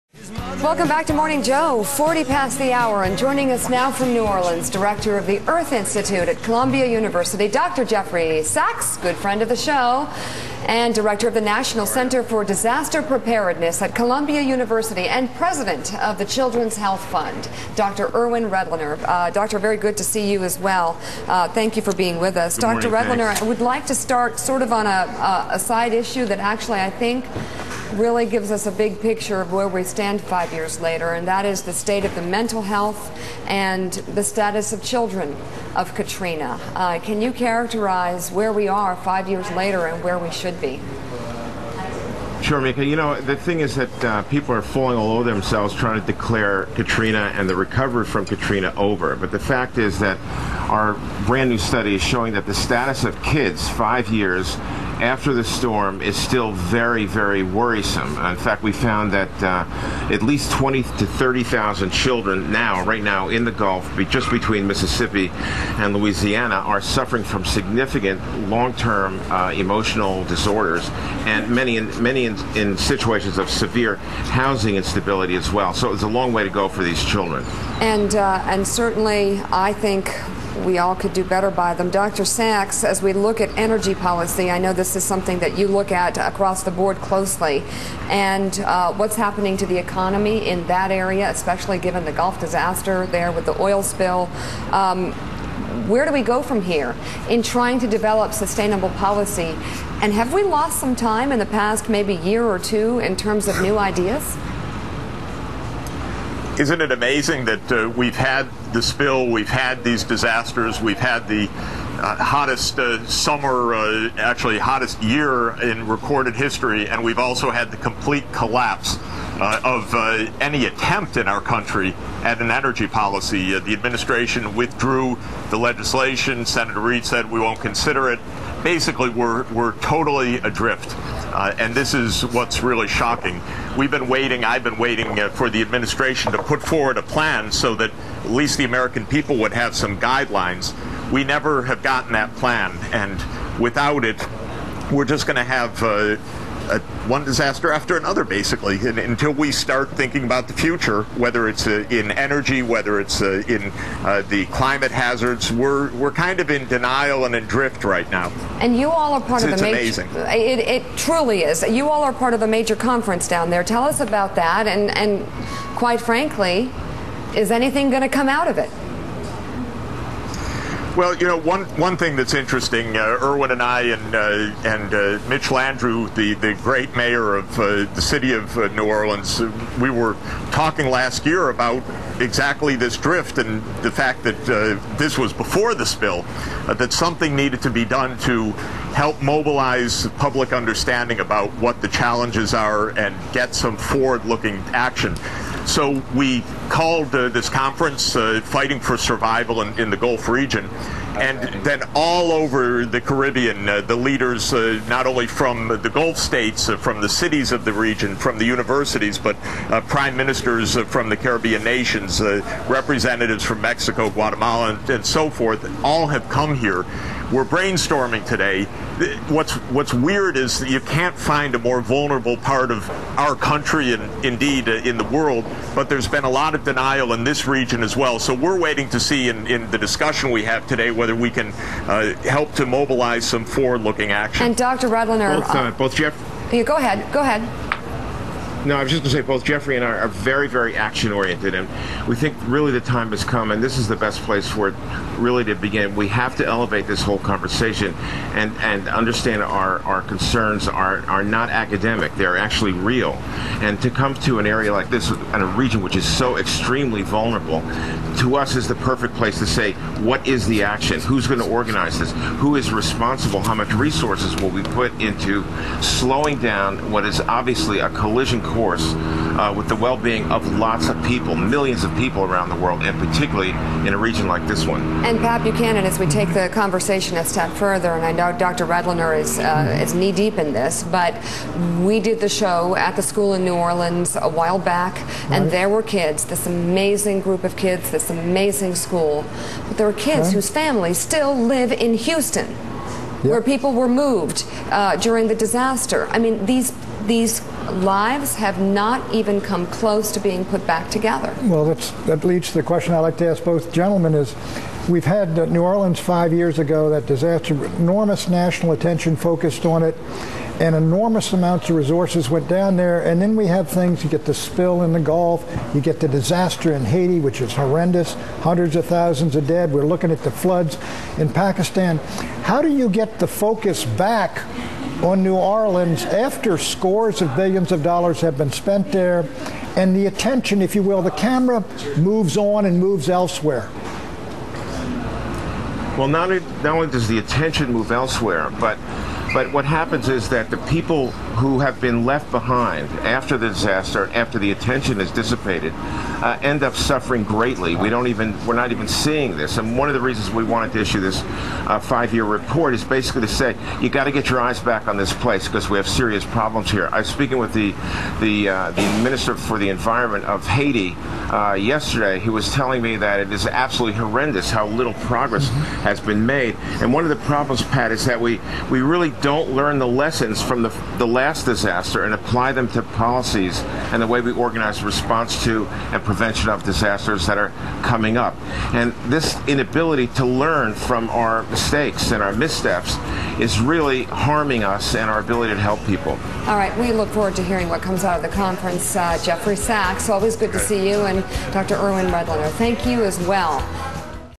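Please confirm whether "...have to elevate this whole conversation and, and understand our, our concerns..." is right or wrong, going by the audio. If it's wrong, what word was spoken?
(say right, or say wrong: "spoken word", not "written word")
right.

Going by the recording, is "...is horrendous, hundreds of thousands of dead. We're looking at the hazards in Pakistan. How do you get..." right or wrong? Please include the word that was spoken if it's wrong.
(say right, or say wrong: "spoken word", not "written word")
wrong: "floods", not "hazards".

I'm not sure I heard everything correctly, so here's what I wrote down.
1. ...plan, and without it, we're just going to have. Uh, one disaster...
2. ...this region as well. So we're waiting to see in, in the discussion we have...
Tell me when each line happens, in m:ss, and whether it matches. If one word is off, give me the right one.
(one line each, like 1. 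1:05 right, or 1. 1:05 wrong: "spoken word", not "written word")
1. 2:22 right
2. 3:47 right.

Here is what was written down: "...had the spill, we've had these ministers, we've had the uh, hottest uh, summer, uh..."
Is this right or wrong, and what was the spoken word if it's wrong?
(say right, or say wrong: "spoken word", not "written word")
wrong: "disasters", not "ministers".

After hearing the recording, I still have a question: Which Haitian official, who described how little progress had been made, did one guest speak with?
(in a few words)
Minister for the Environment.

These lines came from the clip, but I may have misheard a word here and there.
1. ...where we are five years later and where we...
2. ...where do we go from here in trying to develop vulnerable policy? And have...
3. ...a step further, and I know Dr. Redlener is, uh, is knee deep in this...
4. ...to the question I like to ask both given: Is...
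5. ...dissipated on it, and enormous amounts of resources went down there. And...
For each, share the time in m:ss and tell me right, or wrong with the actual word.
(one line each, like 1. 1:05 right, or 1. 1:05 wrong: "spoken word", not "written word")
1. 0:38 right
2. 1:35 wrong: "sustainable", not "vulnerable"
3. 4:37 right
4. 5:02 wrong: "gentlemen", not "given"
5. 5:09 wrong: "focused", not "dissipated".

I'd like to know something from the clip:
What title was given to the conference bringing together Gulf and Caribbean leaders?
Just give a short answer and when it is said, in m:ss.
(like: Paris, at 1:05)
Fighting for Survival, at 3:18.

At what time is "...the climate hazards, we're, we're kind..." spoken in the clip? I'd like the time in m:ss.
2:34.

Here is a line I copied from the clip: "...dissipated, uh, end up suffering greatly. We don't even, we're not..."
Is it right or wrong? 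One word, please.
right.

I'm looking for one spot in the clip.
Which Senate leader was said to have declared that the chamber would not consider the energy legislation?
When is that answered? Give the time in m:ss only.
2:06.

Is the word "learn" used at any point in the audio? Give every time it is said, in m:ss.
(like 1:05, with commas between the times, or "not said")
6:09, 6:20.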